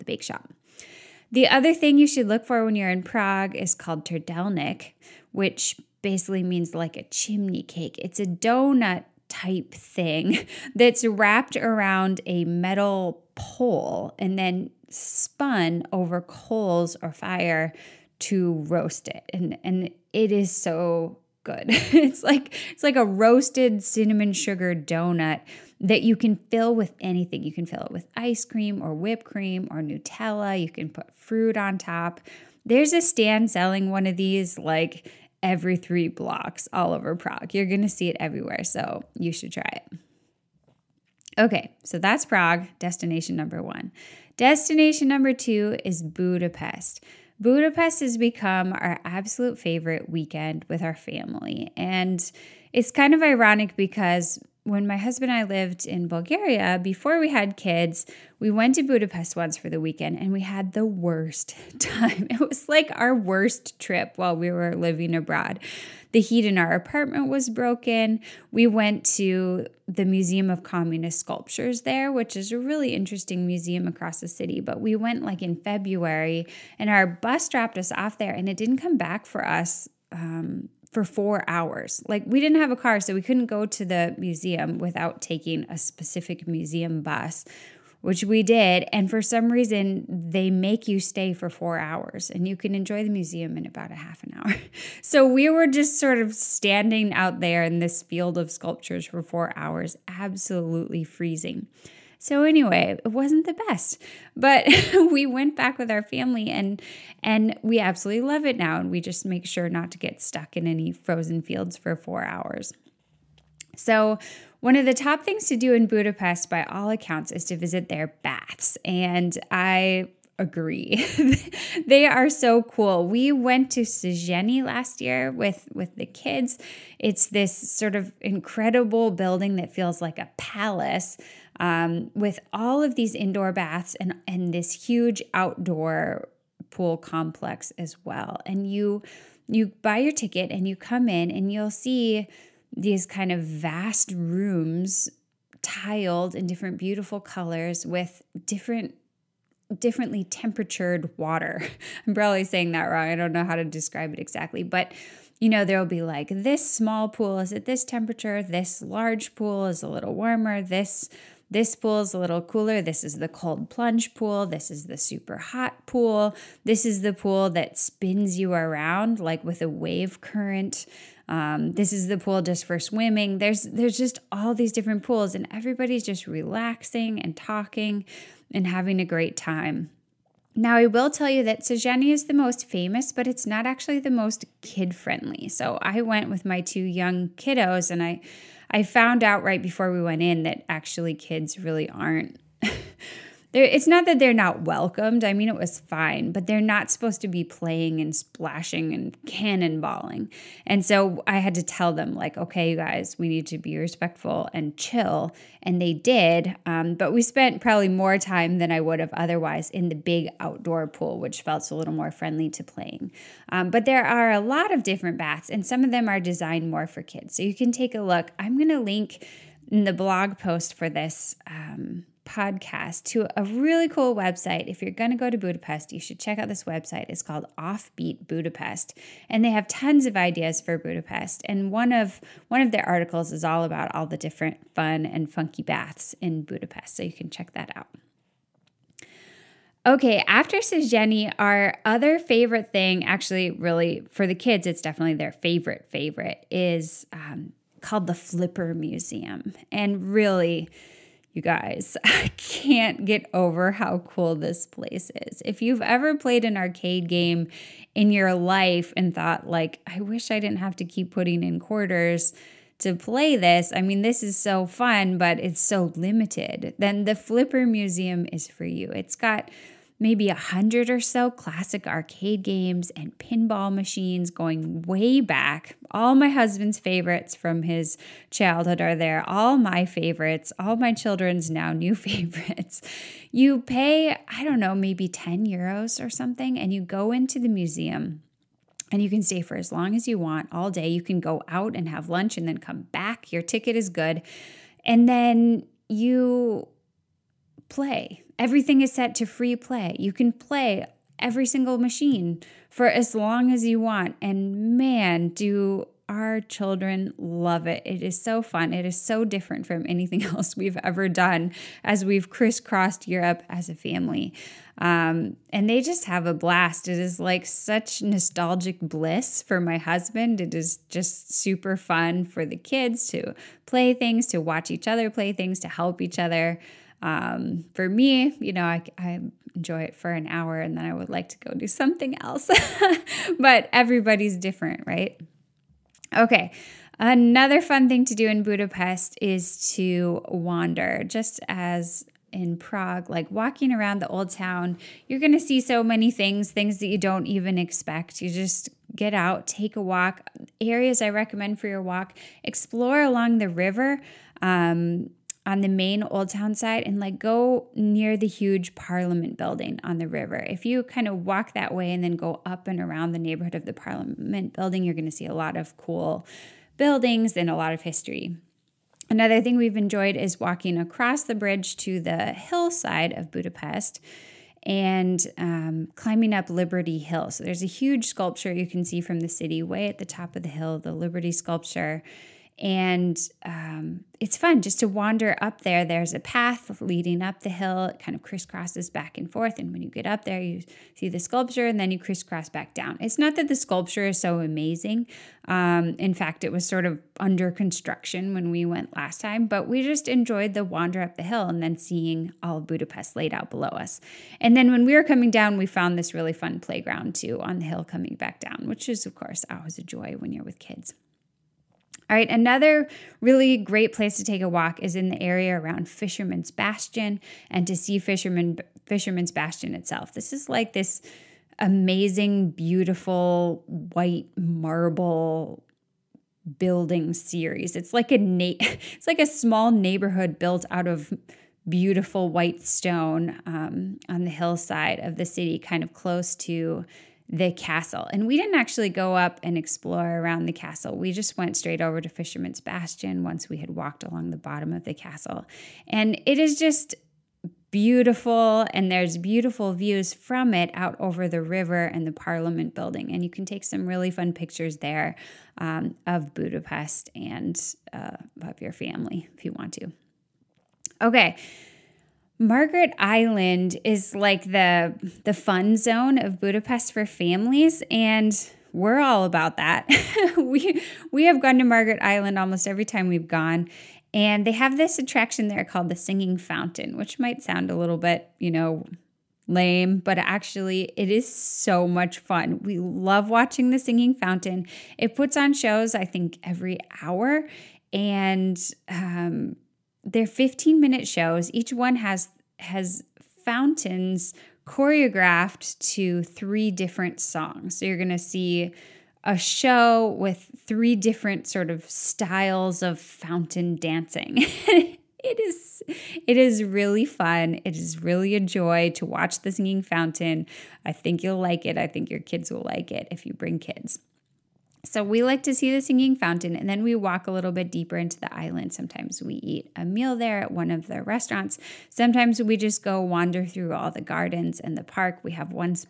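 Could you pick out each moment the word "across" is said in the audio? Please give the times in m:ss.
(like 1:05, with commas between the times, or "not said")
1:13, 6:10.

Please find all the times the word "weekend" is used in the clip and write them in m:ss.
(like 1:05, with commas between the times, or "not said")
0:50, 0:59.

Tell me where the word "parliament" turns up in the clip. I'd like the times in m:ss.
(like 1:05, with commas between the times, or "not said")
5:58, 6:03, 7:32.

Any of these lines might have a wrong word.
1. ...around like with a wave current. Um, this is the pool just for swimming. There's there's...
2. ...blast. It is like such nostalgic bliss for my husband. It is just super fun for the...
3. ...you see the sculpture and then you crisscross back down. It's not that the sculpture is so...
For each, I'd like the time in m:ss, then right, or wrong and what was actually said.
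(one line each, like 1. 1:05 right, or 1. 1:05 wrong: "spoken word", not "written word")
1. 2:48 right
2. 5:16 right
3. 6:30 right.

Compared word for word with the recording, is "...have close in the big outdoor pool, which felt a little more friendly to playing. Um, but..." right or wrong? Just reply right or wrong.
wrong.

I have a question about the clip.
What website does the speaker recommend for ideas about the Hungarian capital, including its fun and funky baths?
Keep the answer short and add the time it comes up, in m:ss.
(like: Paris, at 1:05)
Offbeat Budapest, at 3:47.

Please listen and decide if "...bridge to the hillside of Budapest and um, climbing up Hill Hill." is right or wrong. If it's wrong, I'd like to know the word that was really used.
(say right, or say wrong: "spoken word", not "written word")
wrong: "Liberty", not "Hill".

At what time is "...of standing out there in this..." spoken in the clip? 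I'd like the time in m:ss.
1:36.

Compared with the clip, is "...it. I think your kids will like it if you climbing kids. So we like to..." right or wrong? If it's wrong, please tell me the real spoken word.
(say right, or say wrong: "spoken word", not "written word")
wrong: "bring", not "climbing".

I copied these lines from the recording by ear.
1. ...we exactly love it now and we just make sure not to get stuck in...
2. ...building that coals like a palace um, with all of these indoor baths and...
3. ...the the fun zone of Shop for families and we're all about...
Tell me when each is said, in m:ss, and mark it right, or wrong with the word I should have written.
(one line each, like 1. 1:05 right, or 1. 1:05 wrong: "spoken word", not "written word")
1. 1:47 wrong: "absolutely", not "exactly"
2. 2:09 wrong: "feels", not "coals"
3. 7:44 wrong: "Budapest", not "Shop".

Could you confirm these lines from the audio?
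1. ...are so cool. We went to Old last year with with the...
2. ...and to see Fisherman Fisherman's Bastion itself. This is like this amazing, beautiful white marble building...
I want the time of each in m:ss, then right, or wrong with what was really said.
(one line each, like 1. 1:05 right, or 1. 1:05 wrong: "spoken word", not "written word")
1. 2:02 wrong: "Széchenyi", not "Old"
2. 6:57 right.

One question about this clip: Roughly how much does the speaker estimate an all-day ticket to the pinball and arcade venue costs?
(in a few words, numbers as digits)
10 euros.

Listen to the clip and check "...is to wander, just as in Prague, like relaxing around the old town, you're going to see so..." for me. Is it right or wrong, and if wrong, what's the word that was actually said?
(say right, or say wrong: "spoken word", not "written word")
wrong: "walking", not "relaxing".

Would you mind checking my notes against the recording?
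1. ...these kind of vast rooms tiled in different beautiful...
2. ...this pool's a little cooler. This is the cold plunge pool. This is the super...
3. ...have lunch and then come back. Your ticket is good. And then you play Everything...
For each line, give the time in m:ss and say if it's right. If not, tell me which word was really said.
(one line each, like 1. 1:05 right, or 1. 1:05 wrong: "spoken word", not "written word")
1. 2:22 right
2. 2:41 right
3. 4:51 right.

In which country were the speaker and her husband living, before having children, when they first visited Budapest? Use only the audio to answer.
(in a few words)
Bulgaria.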